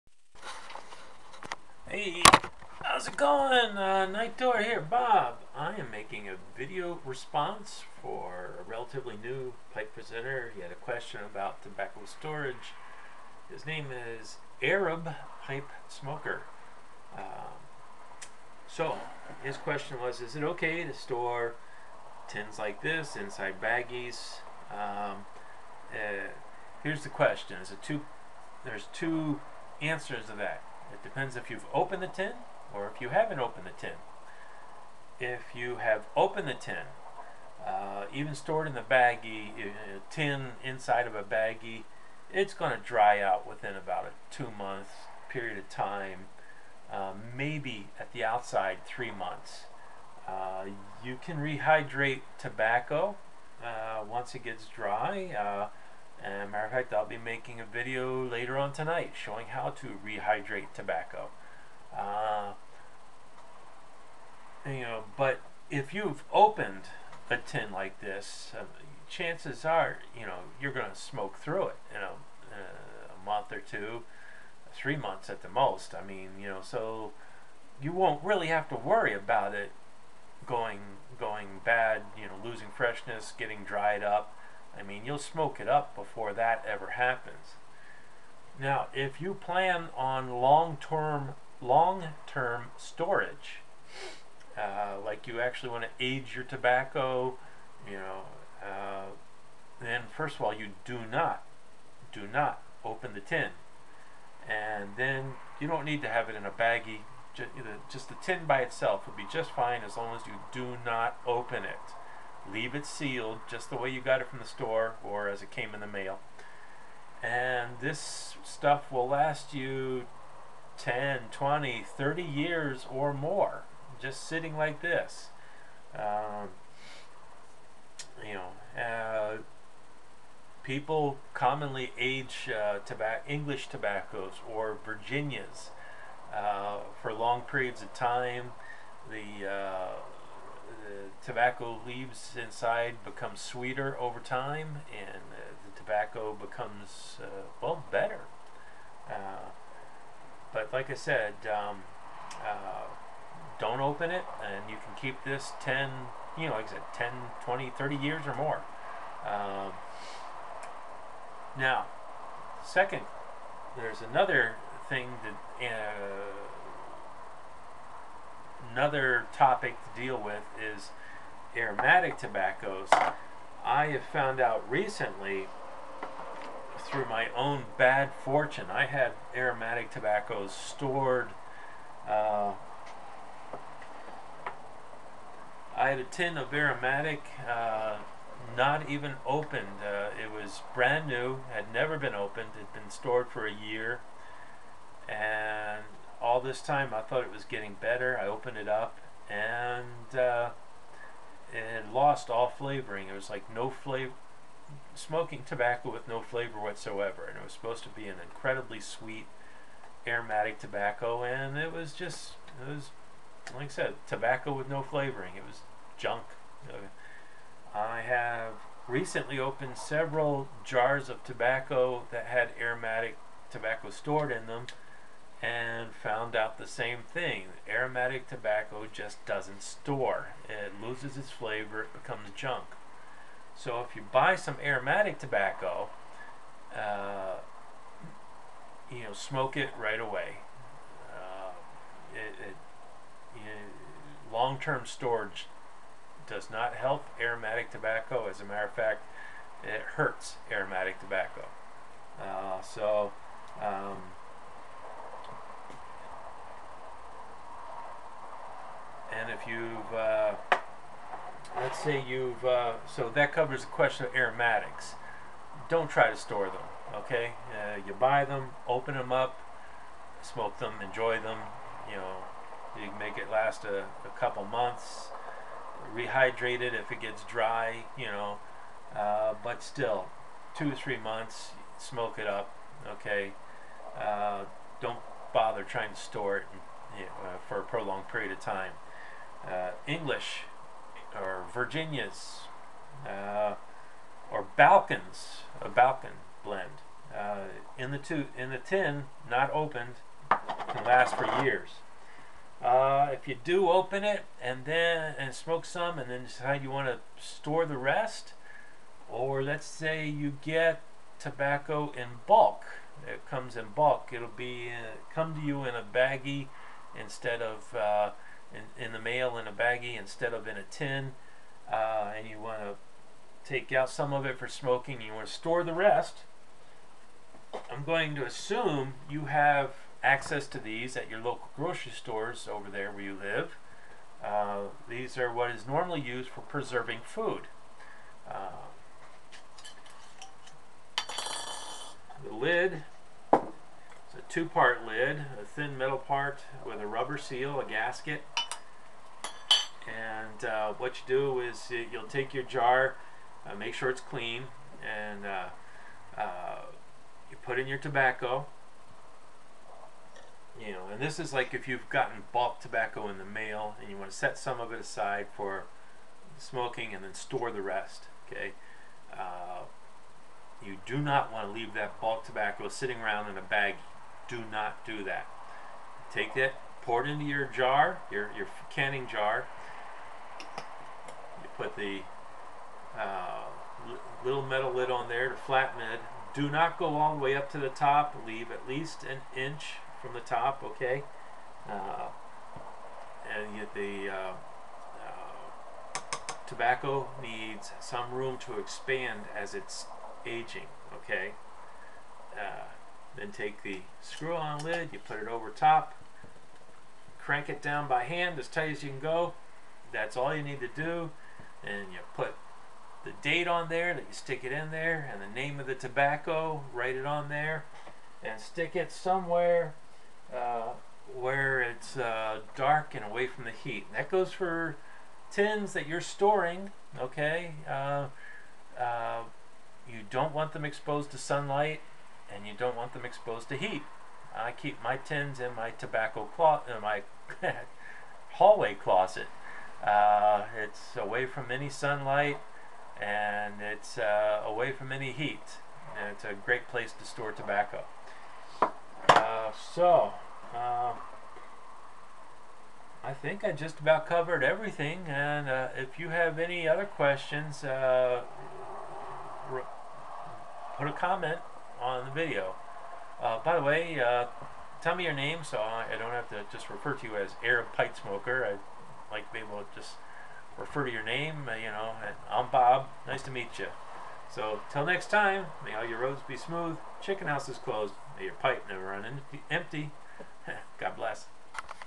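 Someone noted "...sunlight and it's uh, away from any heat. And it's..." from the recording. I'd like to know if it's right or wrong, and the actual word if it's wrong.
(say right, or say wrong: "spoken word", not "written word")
right.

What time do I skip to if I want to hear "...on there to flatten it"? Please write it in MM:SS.
06:24.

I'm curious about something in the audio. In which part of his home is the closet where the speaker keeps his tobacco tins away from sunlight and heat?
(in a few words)
hallway.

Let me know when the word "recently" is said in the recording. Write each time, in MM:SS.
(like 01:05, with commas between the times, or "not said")
02:54, 03:38.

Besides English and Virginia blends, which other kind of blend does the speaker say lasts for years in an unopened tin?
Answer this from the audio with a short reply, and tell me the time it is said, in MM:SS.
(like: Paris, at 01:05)
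Balkan, at 04:55.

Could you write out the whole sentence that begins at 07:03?
And that goes for tins that you're storing, okay?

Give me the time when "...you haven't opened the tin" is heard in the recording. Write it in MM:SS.
00:33.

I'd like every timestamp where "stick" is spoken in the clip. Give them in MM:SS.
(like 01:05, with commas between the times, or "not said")
06:54, 06:58.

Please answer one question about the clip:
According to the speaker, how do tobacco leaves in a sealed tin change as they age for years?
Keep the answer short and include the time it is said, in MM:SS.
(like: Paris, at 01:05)
become sweeter, at 02:23.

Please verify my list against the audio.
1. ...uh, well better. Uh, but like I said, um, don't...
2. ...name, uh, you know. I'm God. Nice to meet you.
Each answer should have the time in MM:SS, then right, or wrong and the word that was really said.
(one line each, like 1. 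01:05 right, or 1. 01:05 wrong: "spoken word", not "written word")
1. 02:27 right
2. 07:51 wrong: "Bob", not "God".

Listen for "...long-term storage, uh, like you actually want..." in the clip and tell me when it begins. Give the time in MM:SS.
01:31.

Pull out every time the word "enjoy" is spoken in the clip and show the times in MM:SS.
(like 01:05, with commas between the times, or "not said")
04:30.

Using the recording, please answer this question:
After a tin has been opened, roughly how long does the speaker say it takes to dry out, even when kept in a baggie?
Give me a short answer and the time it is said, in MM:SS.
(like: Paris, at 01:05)
2 months, at 00:44.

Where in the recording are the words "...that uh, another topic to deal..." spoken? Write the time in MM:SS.
02:45.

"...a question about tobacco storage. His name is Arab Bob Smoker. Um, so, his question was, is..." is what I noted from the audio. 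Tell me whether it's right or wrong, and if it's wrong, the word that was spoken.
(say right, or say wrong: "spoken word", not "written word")
wrong: "Pipe", not "Bob".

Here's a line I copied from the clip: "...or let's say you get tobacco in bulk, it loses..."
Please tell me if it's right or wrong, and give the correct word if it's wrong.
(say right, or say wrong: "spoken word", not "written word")
wrong: "comes", not "loses".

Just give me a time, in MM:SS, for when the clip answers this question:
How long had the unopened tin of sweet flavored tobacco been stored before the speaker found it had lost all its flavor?
03:13.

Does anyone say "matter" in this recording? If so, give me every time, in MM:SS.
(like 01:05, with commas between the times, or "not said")
00:56, 04:08.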